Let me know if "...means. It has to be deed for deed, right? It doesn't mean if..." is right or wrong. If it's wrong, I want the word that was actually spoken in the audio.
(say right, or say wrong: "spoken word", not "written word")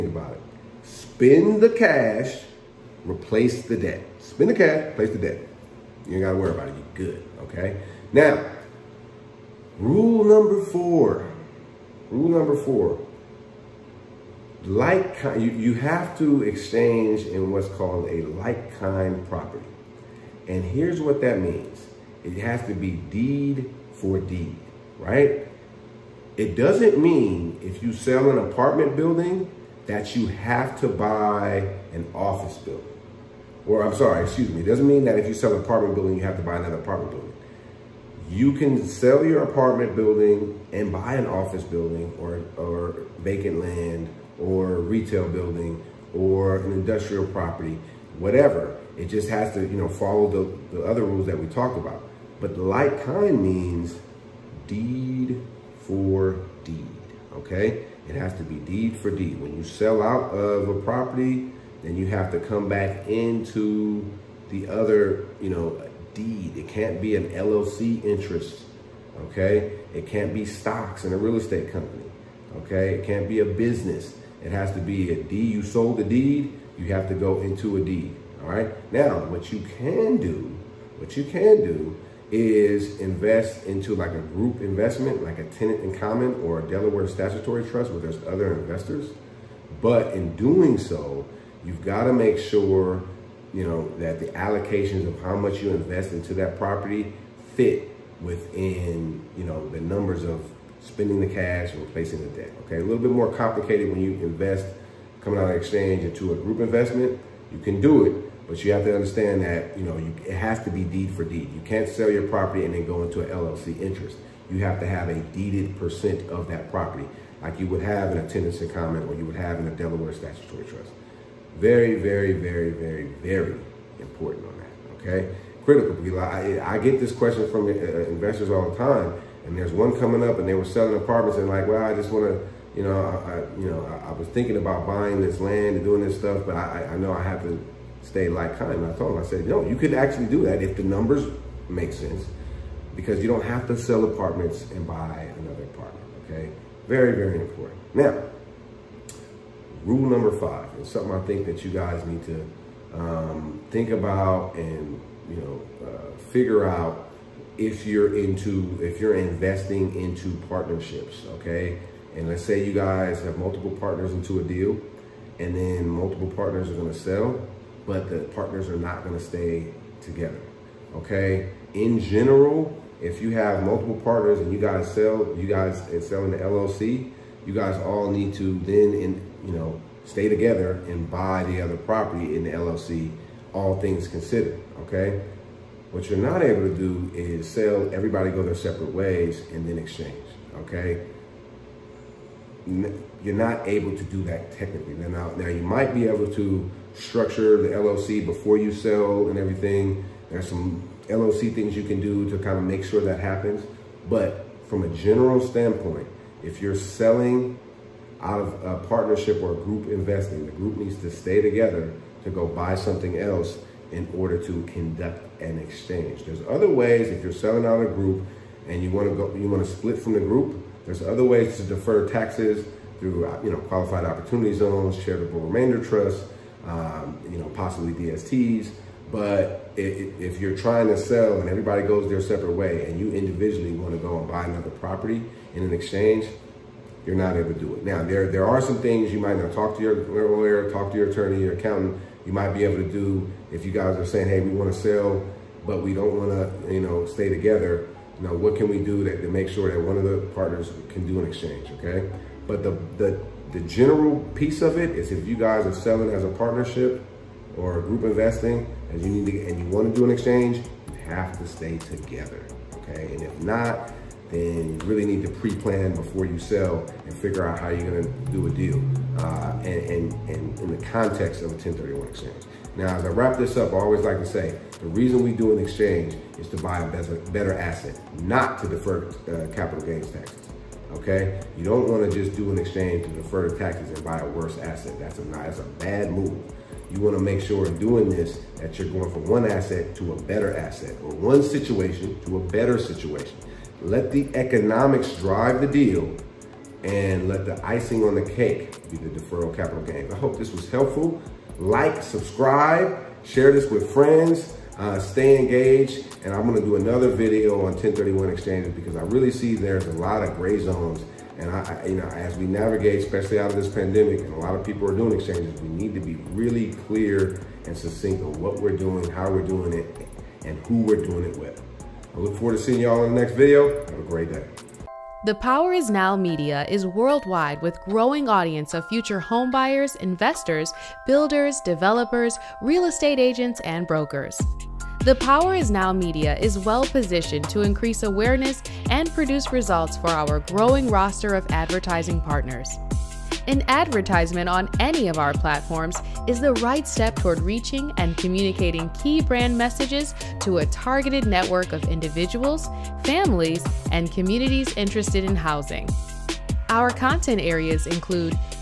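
right.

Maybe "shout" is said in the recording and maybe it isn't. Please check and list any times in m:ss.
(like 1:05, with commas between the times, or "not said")
not said.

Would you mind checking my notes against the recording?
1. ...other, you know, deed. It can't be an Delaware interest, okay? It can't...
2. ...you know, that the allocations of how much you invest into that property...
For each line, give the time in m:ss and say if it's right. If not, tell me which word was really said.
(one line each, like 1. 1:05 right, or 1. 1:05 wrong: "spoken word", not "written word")
1. 1:04 wrong: "LLC", not "Delaware"
2. 1:33 right.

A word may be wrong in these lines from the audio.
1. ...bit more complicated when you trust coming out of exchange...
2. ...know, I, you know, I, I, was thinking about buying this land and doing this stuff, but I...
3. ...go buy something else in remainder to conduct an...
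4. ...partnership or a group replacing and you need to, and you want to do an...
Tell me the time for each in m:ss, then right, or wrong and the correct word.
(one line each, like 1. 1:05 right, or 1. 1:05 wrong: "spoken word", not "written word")
1. 1:42 wrong: "invest", not "trust"
2. 2:12 right
3. 3:32 wrong: "order", not "remainder"
4. 4:16 wrong: "investing", not "replacing".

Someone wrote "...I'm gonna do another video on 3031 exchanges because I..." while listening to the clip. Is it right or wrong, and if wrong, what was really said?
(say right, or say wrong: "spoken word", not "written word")
wrong: "1031", not "3031".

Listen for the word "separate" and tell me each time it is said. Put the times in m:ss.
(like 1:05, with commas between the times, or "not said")
3:08, 3:52.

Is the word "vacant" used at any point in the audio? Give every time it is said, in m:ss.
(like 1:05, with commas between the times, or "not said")
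0:43.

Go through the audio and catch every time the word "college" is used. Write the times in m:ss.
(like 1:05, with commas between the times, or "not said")
not said.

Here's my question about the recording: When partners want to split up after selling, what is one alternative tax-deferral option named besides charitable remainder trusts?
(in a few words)
Qualified opportunity zones.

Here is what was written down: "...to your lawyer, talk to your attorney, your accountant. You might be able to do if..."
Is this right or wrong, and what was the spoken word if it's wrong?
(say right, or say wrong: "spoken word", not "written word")
right.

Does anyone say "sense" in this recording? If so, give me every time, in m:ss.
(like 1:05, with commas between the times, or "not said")
2:21.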